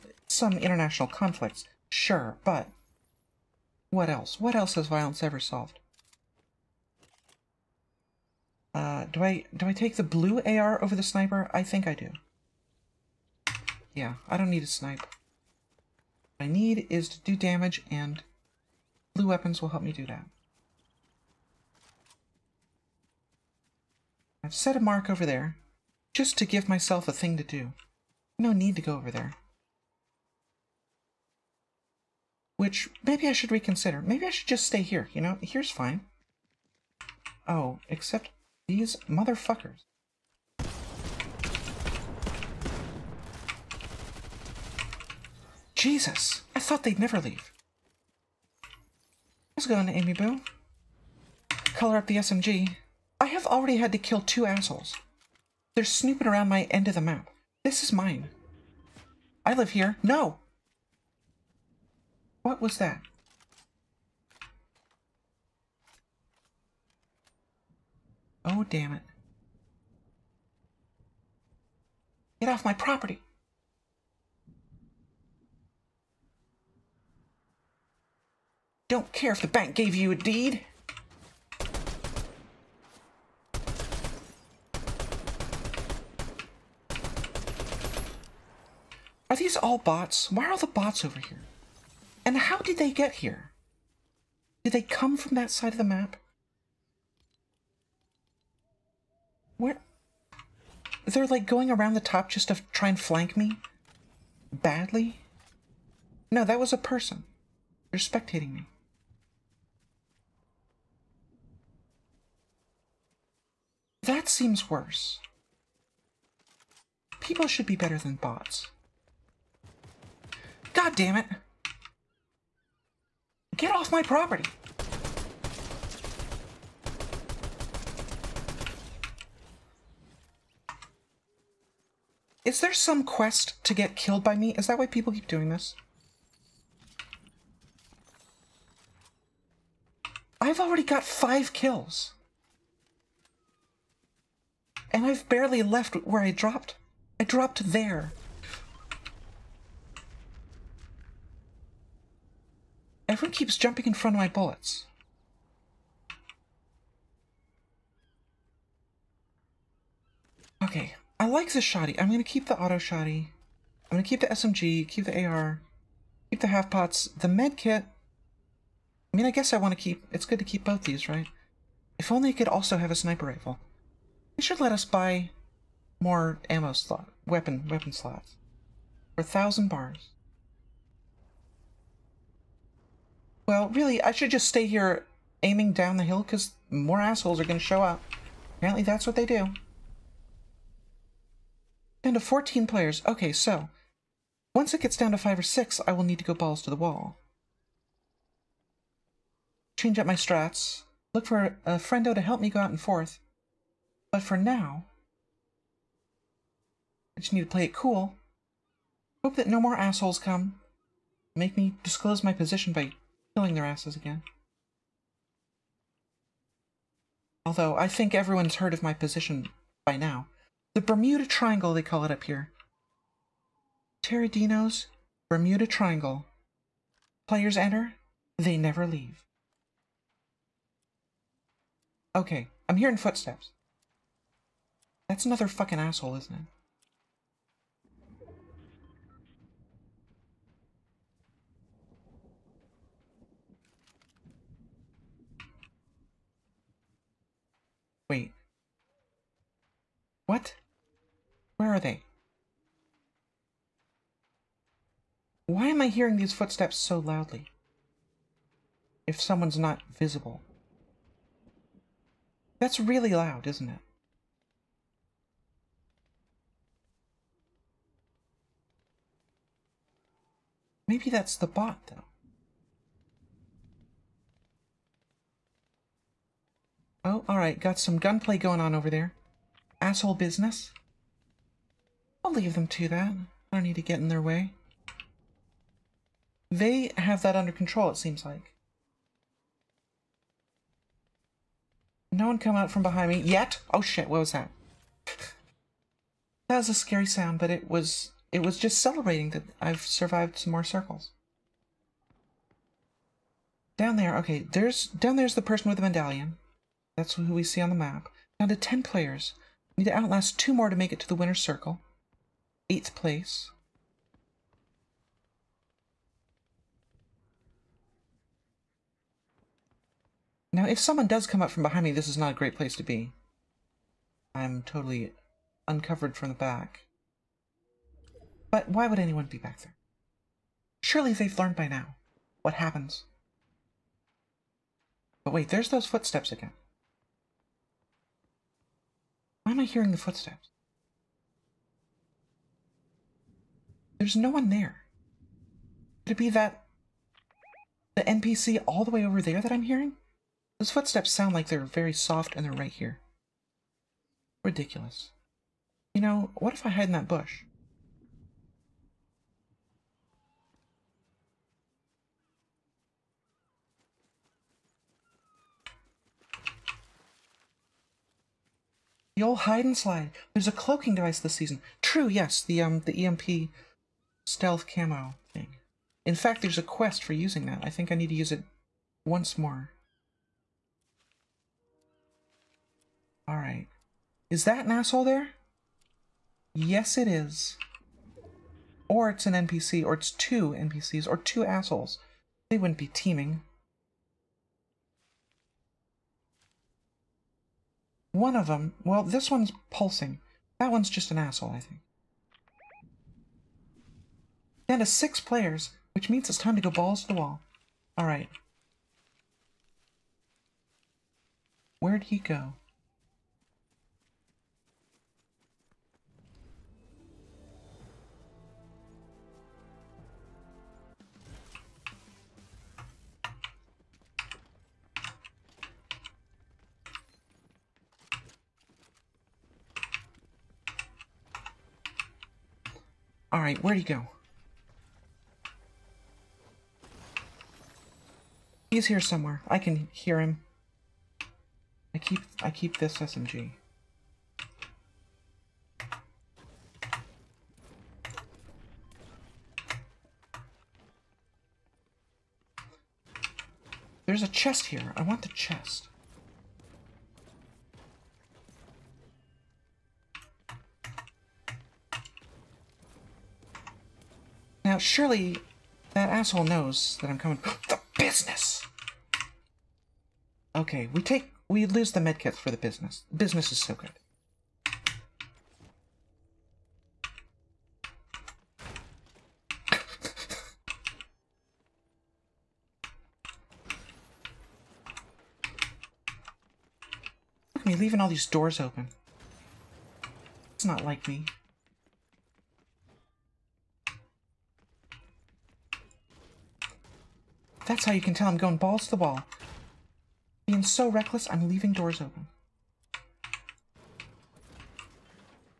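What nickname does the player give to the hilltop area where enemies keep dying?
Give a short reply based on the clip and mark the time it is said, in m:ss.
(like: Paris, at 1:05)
Taradino's Bermuda Triangle, at 3:44.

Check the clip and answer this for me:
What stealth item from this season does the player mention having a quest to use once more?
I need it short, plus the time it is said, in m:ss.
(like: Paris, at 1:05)
EMP stealth camo, at 6:13.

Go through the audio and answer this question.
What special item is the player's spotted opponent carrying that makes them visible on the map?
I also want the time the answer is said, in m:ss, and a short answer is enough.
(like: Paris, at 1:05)
medallion, at 5:05.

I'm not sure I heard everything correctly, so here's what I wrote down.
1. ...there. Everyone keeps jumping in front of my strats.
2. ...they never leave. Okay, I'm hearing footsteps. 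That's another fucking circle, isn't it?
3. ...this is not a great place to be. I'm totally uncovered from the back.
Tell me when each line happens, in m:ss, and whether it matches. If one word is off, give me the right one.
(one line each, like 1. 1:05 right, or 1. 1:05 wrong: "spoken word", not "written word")
1. 2:27 wrong: "bullets", not "strats"
2. 3:48 wrong: "asshole", not "circle"
3. 5:21 right.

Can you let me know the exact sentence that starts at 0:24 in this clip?
I've set a mark over there, just to give myself a thing to do.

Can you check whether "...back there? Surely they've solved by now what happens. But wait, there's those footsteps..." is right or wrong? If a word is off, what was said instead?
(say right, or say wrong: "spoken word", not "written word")
wrong: "learned", not "solved".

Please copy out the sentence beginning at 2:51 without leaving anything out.
If only it could also have a sniper rifle.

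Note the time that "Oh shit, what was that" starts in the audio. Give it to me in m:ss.
4:53.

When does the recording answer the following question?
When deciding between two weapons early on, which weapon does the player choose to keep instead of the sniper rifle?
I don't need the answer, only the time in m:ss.
0:10.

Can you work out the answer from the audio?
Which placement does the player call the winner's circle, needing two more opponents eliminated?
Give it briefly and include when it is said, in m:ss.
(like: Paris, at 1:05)
8th place, at 5:12.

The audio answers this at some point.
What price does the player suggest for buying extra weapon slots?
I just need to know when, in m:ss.
2:59.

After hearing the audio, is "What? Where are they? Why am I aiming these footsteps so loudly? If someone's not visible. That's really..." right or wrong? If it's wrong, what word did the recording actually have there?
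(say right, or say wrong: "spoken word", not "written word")
wrong: "hearing", not "aiming".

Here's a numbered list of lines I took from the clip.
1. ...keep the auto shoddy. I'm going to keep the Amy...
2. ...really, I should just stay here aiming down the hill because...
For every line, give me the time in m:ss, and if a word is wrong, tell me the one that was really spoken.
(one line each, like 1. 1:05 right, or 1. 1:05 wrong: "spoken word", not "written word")
1. 2:42 wrong: "SMG", not "Amy"
2. 3:03 right.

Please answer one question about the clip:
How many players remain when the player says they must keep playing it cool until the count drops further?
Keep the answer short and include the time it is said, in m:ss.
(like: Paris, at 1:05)
14, at 3:12.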